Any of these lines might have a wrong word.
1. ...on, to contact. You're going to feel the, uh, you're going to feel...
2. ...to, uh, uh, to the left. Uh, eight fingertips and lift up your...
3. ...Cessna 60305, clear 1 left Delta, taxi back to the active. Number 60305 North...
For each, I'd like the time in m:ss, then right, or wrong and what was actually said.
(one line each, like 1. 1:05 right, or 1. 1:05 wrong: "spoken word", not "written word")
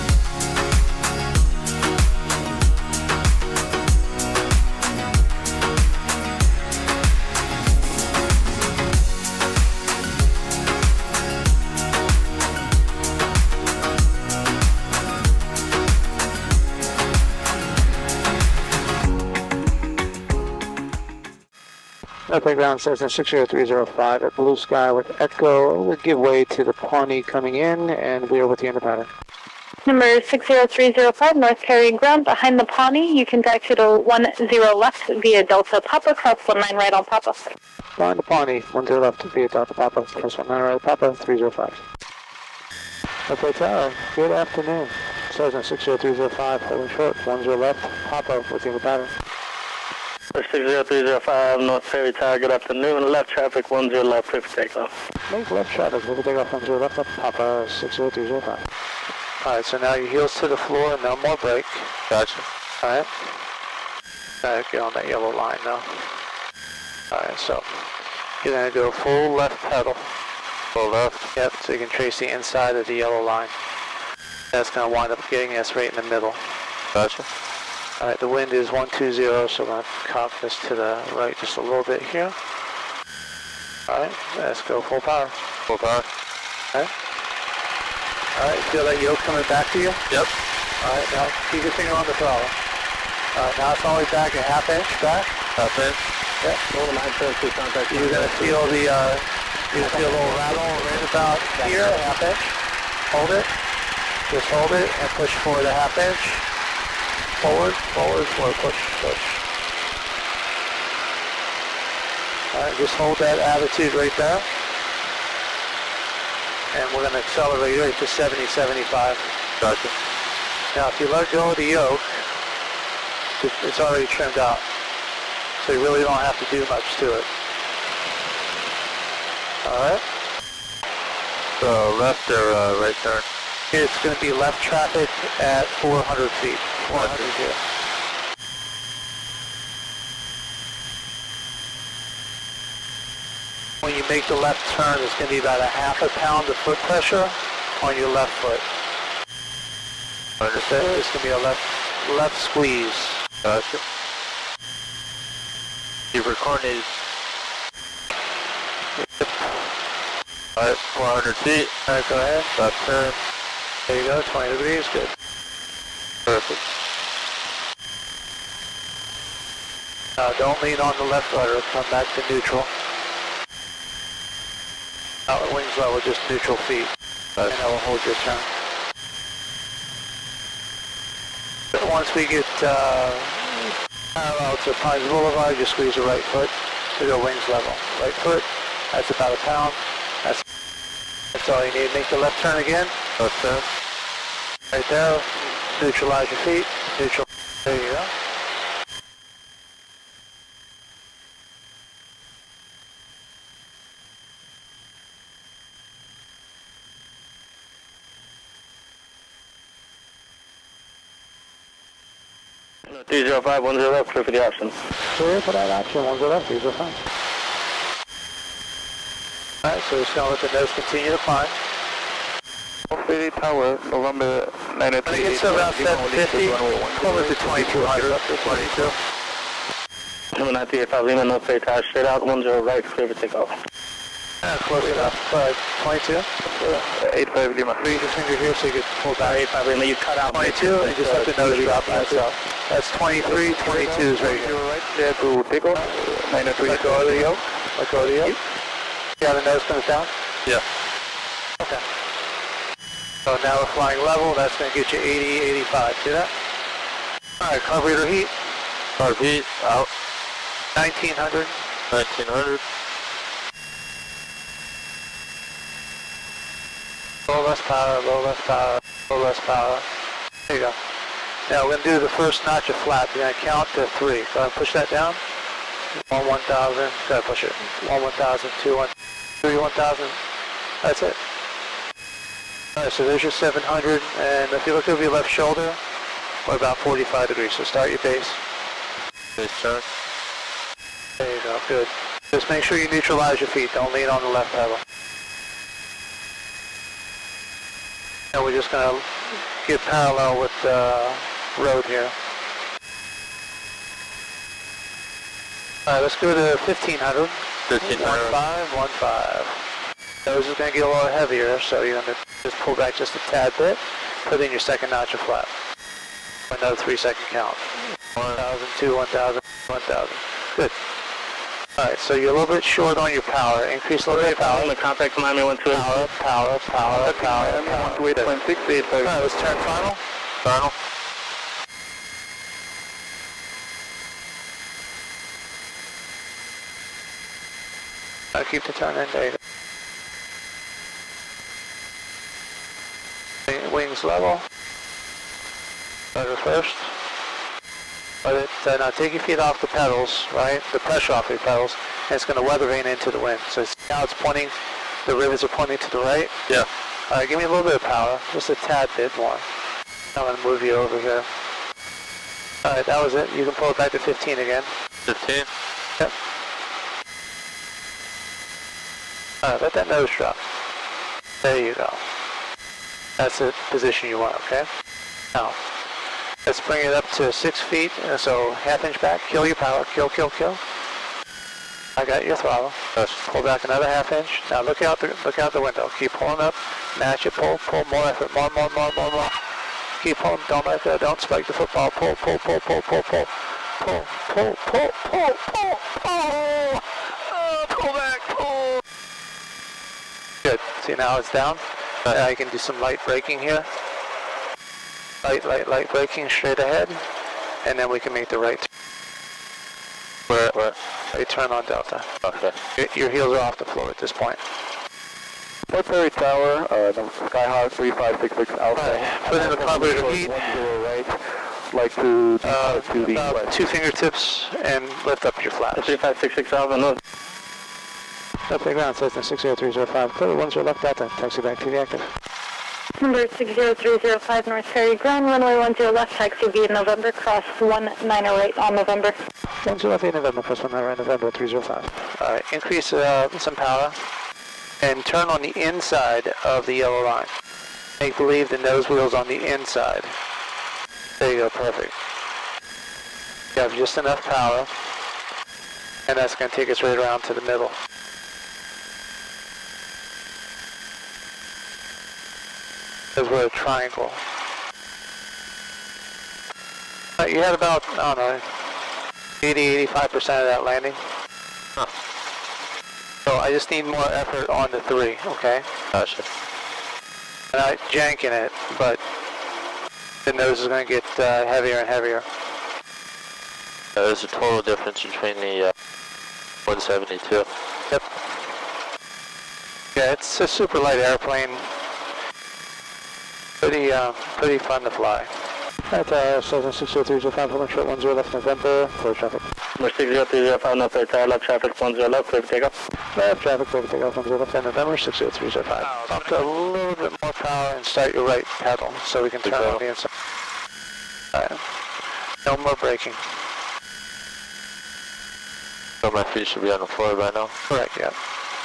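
1. 1:36 right
2. 7:01 wrong: "two", not "eight"
3. 7:08 right.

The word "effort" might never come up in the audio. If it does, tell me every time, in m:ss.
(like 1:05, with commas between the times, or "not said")
6:28, 7:54.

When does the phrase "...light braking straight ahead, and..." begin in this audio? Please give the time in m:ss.
6:45.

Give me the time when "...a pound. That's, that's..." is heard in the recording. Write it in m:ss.
3:09.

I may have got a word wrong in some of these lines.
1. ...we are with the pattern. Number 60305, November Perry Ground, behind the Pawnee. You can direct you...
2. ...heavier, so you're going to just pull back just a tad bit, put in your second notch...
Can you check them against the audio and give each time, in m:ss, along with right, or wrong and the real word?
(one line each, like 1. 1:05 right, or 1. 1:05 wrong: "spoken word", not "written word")
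1. 0:28 wrong: "North", not "November"
2. 5:11 right.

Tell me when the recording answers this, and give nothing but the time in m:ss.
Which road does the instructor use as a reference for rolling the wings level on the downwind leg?
3:04.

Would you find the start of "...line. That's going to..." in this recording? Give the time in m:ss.
1:13.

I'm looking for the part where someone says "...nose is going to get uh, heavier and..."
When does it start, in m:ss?
8:00.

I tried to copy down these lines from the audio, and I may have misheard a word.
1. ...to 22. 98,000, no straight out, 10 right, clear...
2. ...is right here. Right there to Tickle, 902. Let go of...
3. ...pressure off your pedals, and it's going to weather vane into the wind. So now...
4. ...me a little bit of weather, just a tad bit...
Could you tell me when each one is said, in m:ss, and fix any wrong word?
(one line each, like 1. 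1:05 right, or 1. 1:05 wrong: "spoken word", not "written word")
1. 3:48 right
2. 4:04 wrong: "903", not "902"
3. 5:50 right
4. 5:57 wrong: "power", not "weather".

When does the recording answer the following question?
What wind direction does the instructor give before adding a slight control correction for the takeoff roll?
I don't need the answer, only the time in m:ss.
1:18.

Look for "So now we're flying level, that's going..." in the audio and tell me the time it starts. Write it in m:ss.
4:13.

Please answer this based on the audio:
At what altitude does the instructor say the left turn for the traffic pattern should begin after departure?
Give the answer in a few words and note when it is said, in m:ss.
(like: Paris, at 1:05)
400 feet, at 2:14.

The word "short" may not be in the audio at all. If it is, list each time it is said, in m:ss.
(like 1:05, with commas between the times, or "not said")
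0:46, 5:22, 8:17.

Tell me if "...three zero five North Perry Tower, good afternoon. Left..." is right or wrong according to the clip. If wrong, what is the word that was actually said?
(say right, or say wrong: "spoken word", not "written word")
right.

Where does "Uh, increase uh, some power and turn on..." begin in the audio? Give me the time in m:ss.
7:22.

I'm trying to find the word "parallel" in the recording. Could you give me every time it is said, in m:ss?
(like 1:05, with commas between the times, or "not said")
3:04, 4:59.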